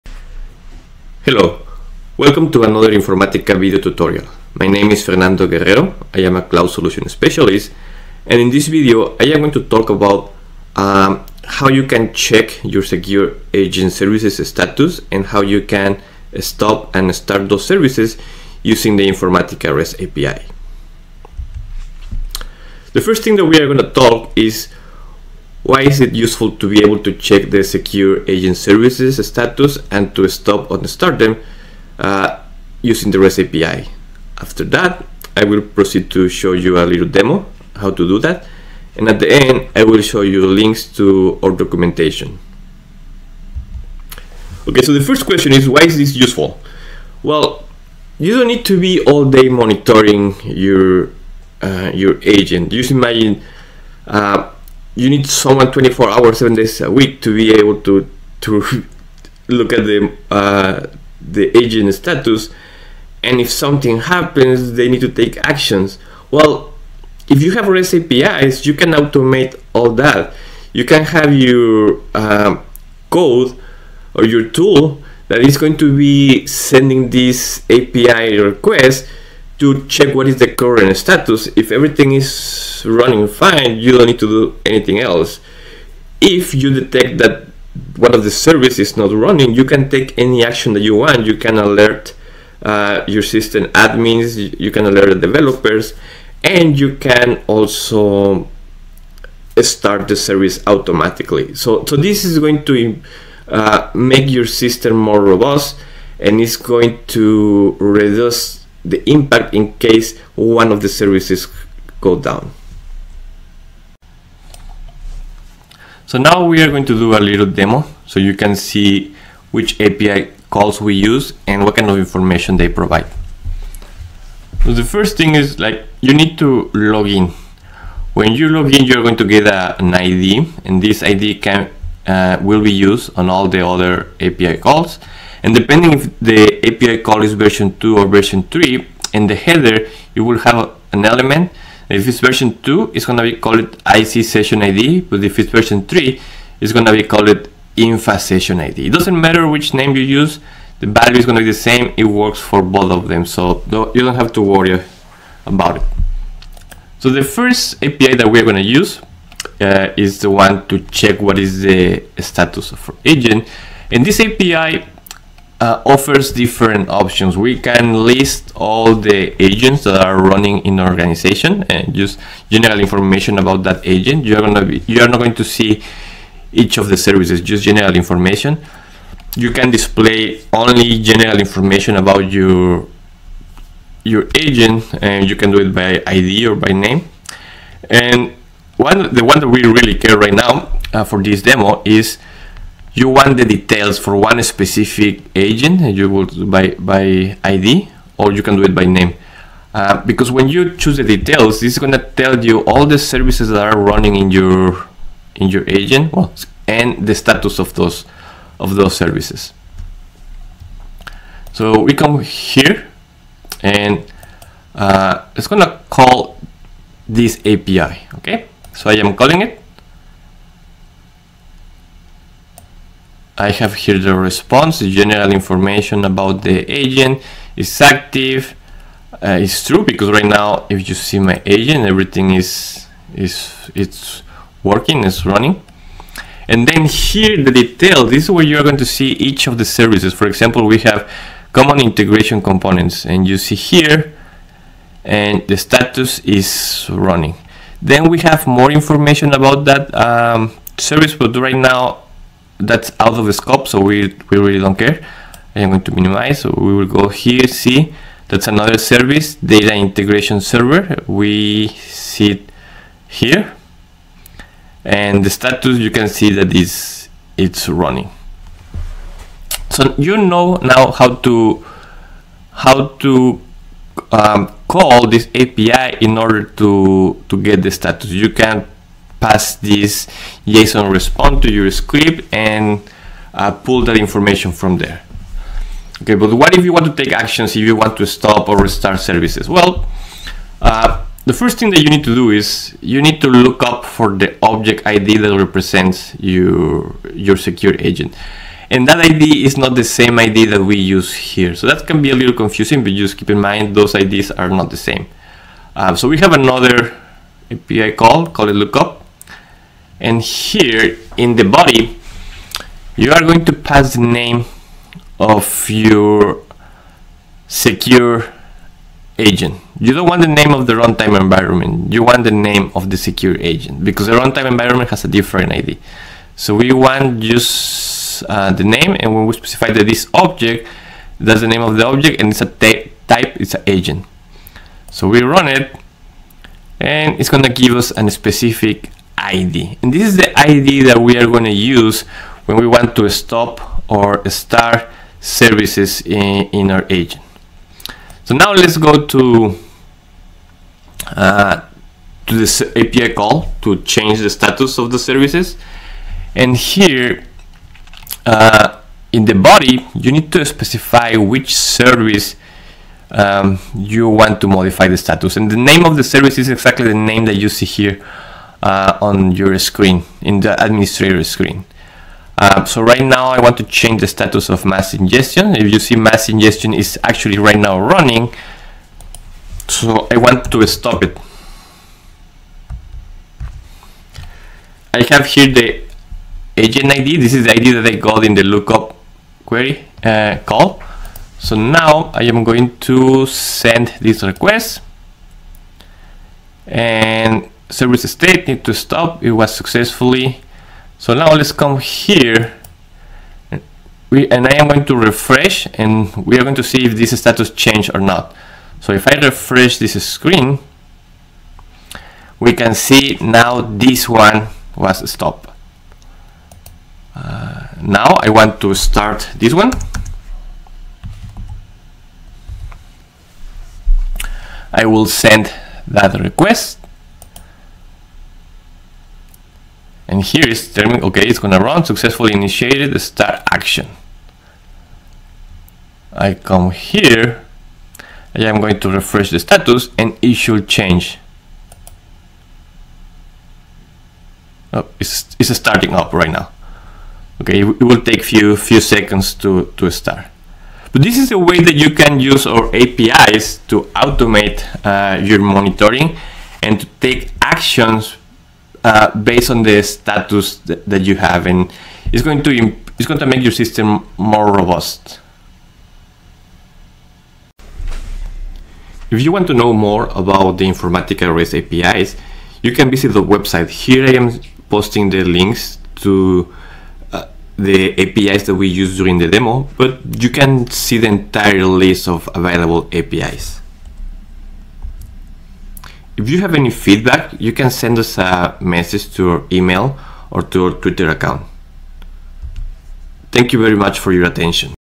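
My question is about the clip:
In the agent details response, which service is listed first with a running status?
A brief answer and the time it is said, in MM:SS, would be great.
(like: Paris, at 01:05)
common integration components, at 04:01.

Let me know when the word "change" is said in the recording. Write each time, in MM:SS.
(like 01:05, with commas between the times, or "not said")
05:53, 06:13, 06:47, 07:20.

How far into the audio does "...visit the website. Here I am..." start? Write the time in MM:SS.
07:52.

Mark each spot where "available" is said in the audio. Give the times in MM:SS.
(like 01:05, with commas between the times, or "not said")
08:02.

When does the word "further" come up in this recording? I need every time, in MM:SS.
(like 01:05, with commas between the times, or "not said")
not said.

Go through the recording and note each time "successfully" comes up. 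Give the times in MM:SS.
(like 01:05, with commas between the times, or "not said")
06:39, 07:11.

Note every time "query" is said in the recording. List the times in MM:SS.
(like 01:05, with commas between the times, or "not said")
06:29.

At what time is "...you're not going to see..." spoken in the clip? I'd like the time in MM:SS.
02:54.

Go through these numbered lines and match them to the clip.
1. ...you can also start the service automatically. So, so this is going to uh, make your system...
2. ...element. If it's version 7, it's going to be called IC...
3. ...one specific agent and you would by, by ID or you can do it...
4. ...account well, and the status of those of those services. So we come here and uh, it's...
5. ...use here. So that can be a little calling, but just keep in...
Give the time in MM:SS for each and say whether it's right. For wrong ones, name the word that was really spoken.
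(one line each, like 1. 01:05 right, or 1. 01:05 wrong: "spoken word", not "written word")
1. 01:36 right
2. 02:21 wrong: "2", not "7"
3. 03:14 right
4. 03:25 wrong: "agent", not "account"
5. 05:00 wrong: "confusing", not "calling".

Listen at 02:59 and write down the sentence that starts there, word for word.
You can display only general information about your your agent, and you can do it by ID or by name.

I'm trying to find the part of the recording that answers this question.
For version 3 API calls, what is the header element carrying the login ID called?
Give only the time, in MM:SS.
02:27.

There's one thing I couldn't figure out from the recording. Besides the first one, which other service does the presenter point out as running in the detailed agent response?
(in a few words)
data integration server.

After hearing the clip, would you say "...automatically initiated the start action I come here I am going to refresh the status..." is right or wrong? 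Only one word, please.
wrong.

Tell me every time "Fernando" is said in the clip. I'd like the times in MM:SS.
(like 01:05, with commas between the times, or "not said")
00:05.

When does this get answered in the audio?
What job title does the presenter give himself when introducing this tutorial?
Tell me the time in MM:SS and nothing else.
00:06.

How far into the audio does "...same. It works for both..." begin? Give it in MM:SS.
02:31.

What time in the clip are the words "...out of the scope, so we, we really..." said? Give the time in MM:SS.
04:12.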